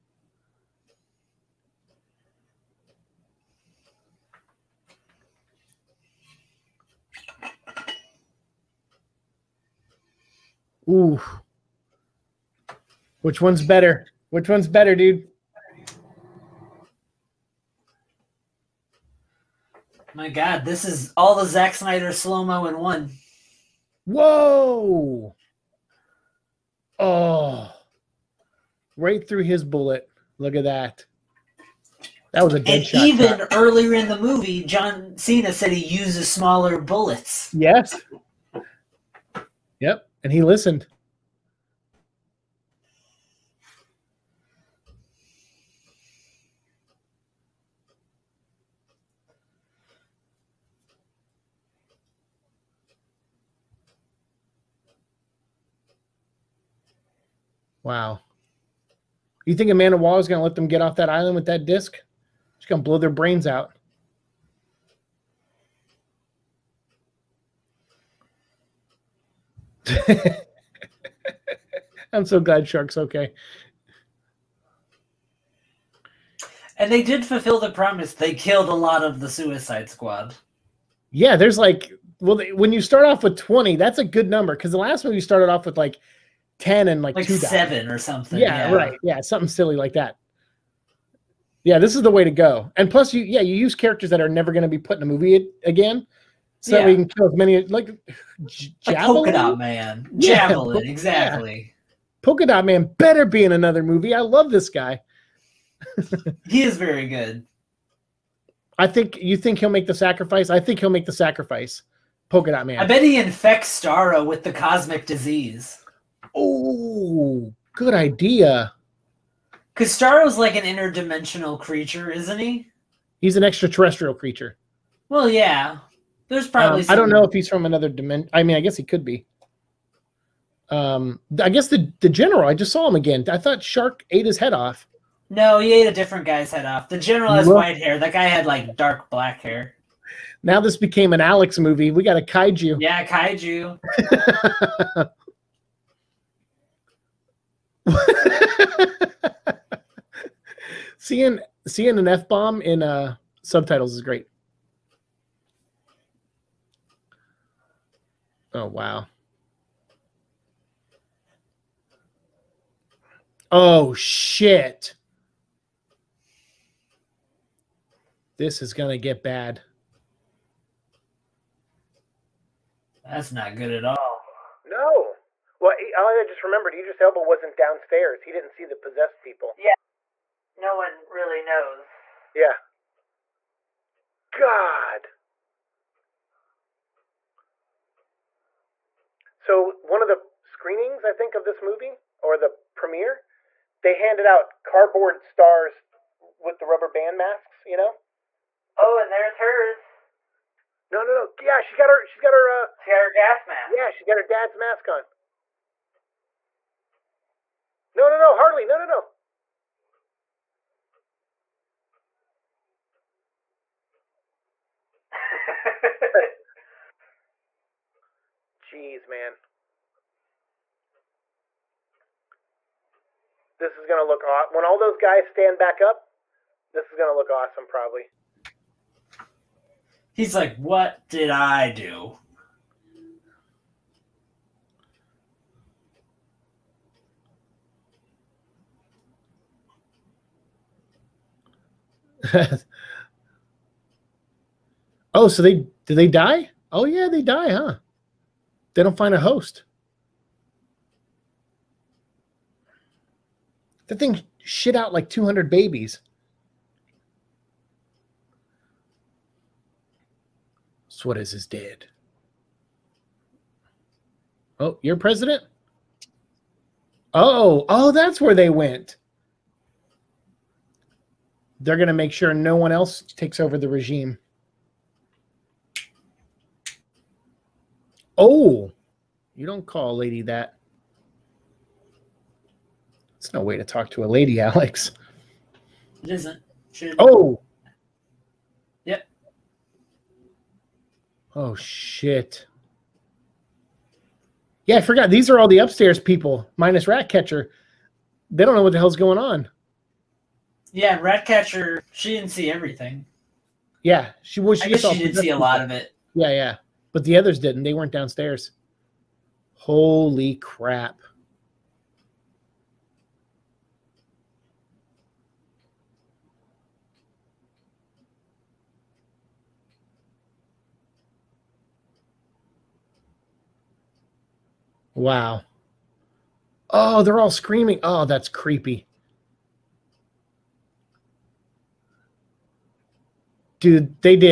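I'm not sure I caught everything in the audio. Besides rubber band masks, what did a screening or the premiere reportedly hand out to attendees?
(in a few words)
Cardboard stars.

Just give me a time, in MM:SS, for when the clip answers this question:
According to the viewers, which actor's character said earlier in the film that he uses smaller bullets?
00:34.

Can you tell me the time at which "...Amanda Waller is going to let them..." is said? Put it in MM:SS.
00:59.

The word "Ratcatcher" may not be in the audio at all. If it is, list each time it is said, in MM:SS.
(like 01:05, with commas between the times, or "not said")
04:56, 05:01.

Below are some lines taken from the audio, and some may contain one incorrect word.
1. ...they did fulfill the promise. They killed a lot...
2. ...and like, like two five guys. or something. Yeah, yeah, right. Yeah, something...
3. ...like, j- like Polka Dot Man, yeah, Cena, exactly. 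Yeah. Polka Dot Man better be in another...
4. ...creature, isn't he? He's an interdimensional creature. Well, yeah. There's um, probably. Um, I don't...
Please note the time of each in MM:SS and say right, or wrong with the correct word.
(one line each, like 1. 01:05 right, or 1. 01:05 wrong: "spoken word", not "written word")
1. 01:16 right
2. 01:26 wrong: "seven", not "five"
3. 01:37 wrong: "Javelin", not "Cena"
4. 02:01 wrong: "extraterrestrial", not "interdimensional".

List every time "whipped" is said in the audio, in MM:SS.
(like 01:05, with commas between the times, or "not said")
not said.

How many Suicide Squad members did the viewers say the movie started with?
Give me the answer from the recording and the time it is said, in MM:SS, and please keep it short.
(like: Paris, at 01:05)
20, at 01:23.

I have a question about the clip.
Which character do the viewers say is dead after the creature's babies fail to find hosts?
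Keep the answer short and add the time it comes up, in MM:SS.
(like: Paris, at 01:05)
Suarez, at 04:20.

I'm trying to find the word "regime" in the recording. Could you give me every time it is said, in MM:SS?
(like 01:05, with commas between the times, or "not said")
04:33.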